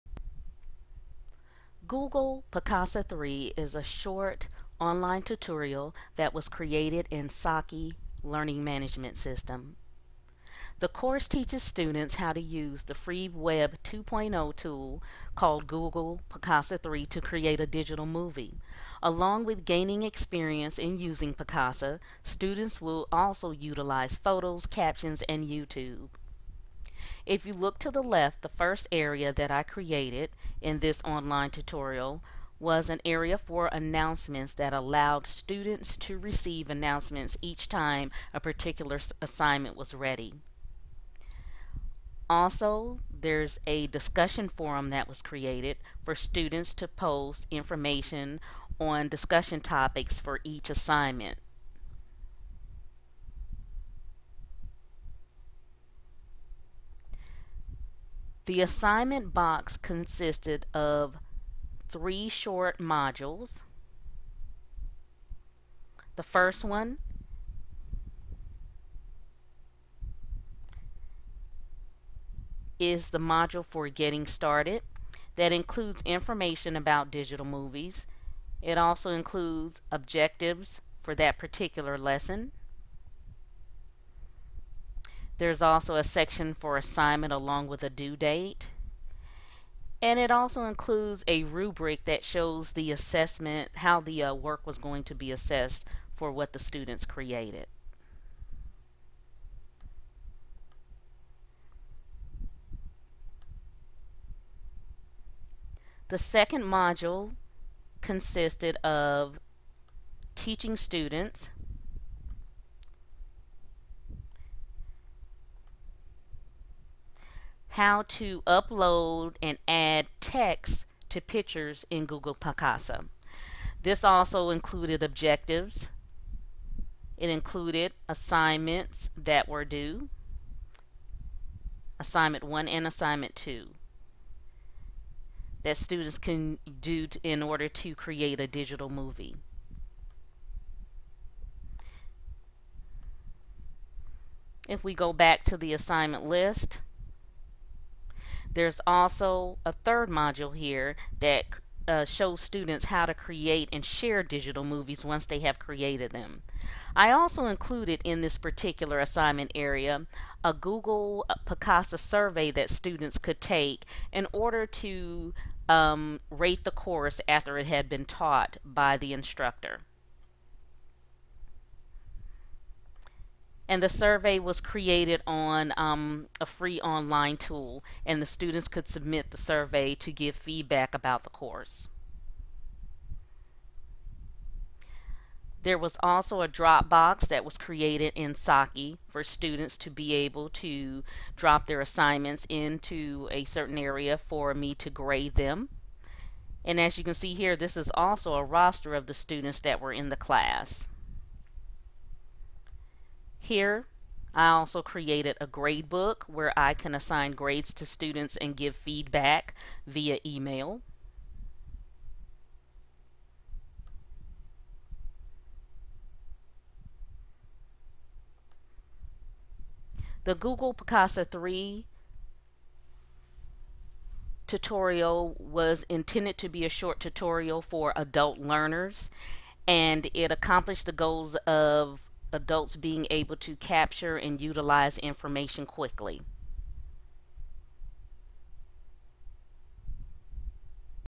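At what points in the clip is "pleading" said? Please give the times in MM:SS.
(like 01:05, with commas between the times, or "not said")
not said.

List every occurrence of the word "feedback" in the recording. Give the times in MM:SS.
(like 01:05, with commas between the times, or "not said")
03:00, 03:28.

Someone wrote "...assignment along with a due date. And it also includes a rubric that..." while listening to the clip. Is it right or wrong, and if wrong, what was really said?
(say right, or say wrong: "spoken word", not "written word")
right.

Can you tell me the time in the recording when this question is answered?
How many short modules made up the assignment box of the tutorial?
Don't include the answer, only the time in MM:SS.
01:01.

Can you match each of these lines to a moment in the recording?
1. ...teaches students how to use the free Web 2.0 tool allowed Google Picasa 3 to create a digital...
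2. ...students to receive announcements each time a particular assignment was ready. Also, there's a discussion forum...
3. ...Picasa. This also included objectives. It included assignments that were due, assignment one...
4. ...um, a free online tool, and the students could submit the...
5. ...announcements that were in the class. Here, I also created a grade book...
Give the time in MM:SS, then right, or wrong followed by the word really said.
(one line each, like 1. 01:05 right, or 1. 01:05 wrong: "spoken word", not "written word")
1. 00:11 wrong: "called", not "allowed"
2. 00:35 right
3. 02:02 right
4. 02:55 right
5. 03:19 wrong: "students", not "announcements".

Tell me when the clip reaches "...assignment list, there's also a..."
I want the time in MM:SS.
02:25.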